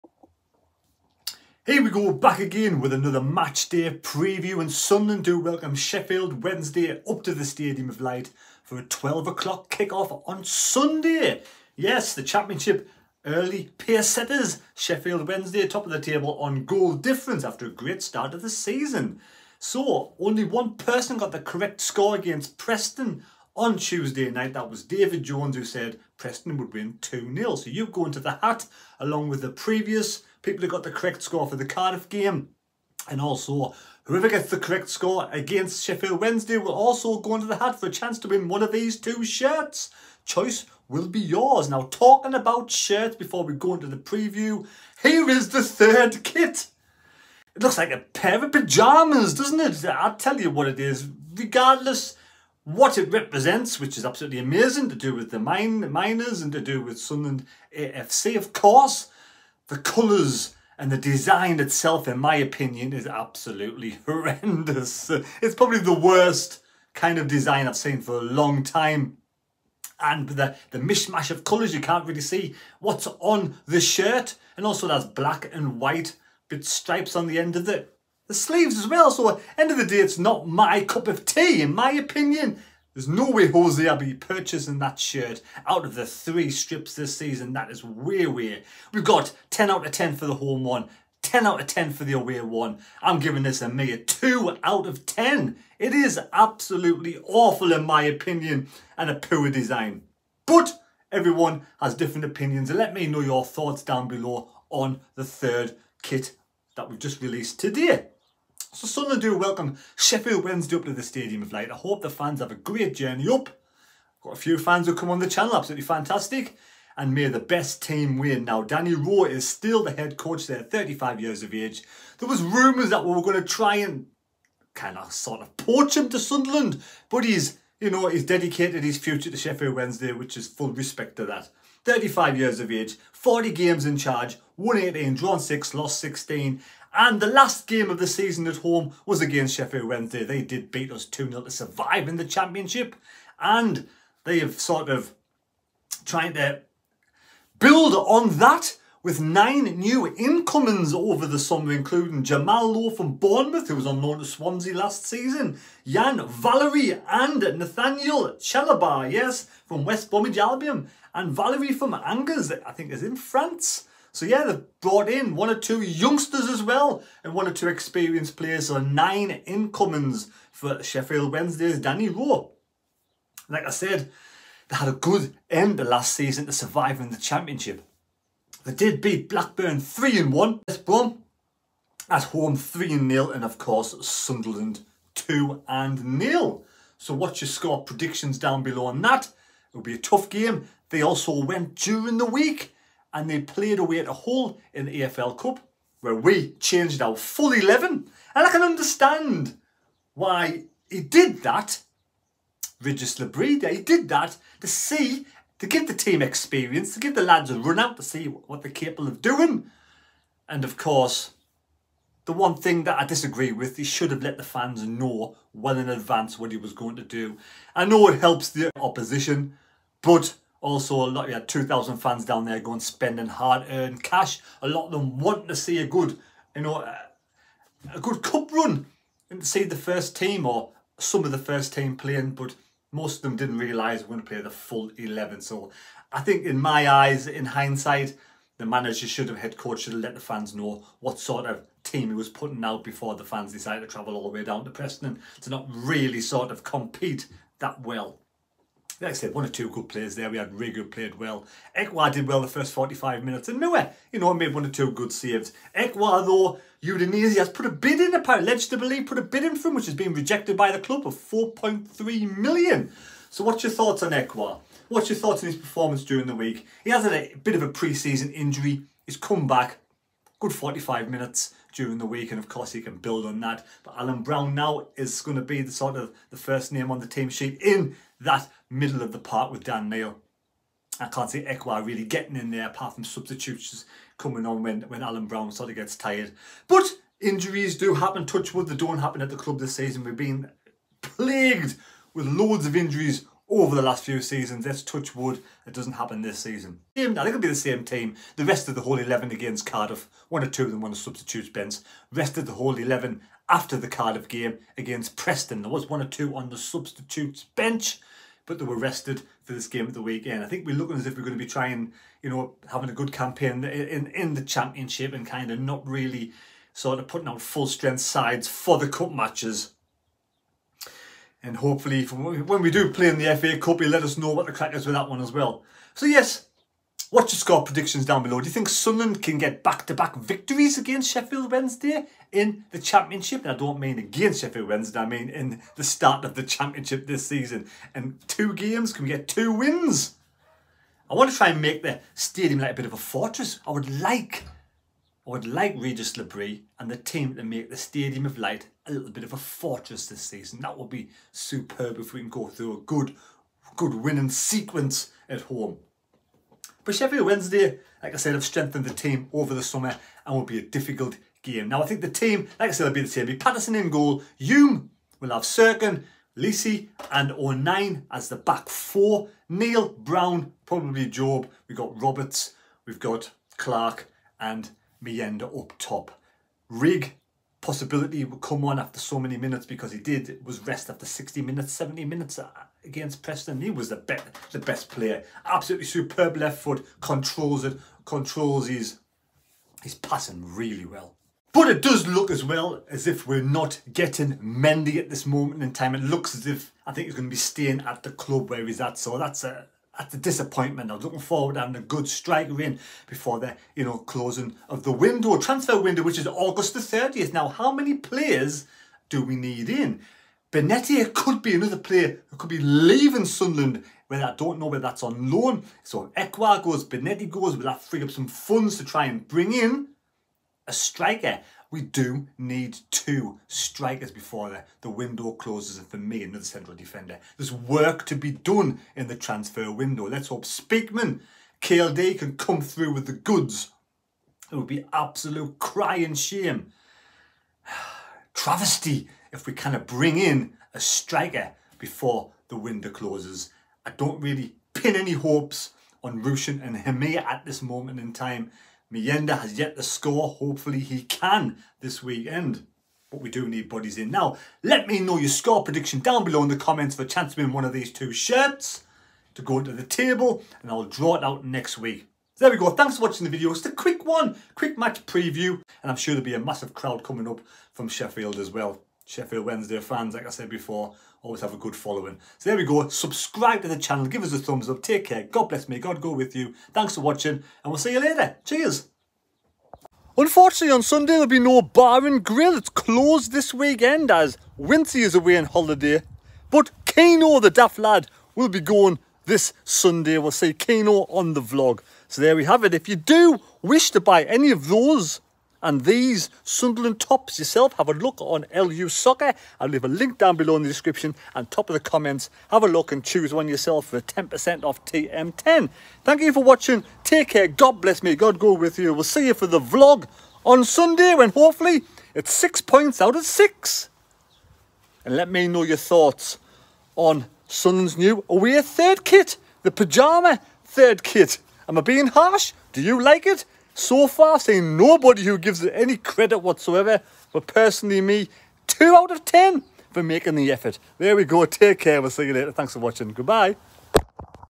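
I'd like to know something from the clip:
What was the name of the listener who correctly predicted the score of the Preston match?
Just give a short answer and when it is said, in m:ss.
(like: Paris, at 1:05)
David Jones, at 0:24.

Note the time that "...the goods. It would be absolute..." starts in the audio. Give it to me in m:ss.
7:13.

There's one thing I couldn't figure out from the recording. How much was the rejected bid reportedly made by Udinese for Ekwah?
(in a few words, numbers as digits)
4.3 million.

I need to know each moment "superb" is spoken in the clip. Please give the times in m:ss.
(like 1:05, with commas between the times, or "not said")
5:51, 6:25.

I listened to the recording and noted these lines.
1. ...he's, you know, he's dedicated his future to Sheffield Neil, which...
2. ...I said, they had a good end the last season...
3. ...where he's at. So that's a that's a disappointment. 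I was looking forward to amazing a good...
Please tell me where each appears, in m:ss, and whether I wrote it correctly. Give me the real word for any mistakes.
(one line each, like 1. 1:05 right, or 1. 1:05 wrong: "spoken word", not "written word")
1. 2:07 wrong: "Wednesday", not "Neil"
2. 2:53 right
3. 6:38 wrong: "having", not "amazing".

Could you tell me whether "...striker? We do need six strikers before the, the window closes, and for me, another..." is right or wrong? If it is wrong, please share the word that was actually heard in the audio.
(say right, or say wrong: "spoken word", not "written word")
wrong: "two", not "six".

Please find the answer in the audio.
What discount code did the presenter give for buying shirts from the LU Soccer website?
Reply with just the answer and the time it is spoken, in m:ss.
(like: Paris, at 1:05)
TM10, at 8:24.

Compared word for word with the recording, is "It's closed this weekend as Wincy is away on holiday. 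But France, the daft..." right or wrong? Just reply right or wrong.
wrong.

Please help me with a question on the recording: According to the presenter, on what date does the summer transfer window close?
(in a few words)
August 30th.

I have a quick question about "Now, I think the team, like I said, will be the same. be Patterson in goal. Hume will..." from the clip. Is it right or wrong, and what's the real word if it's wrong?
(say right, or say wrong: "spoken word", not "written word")
right.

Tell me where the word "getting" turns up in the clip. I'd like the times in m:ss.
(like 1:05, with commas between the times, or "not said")
4:42, 6:33.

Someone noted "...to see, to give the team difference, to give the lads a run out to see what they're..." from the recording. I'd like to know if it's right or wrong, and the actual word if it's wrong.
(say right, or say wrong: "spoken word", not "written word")
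wrong: "experience", not "difference".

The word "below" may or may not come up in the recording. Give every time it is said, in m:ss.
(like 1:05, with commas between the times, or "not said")
1:44, 3:08, 5:28, 7:36, 8:20.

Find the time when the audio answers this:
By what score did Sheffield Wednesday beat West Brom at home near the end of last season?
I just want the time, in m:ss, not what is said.
3:02.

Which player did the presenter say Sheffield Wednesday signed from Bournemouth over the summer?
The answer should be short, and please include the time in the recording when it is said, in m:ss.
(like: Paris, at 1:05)
Jamal Lowe, at 2:32.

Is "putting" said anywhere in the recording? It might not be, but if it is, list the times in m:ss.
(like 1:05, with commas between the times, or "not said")
4:02, 5:17.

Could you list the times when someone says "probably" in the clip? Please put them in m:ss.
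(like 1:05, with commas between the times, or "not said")
1:05, 6:10.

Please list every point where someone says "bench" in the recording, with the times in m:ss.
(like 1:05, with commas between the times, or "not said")
5:01, 5:07.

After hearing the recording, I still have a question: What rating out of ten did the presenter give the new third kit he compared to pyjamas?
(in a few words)
2 out of 10.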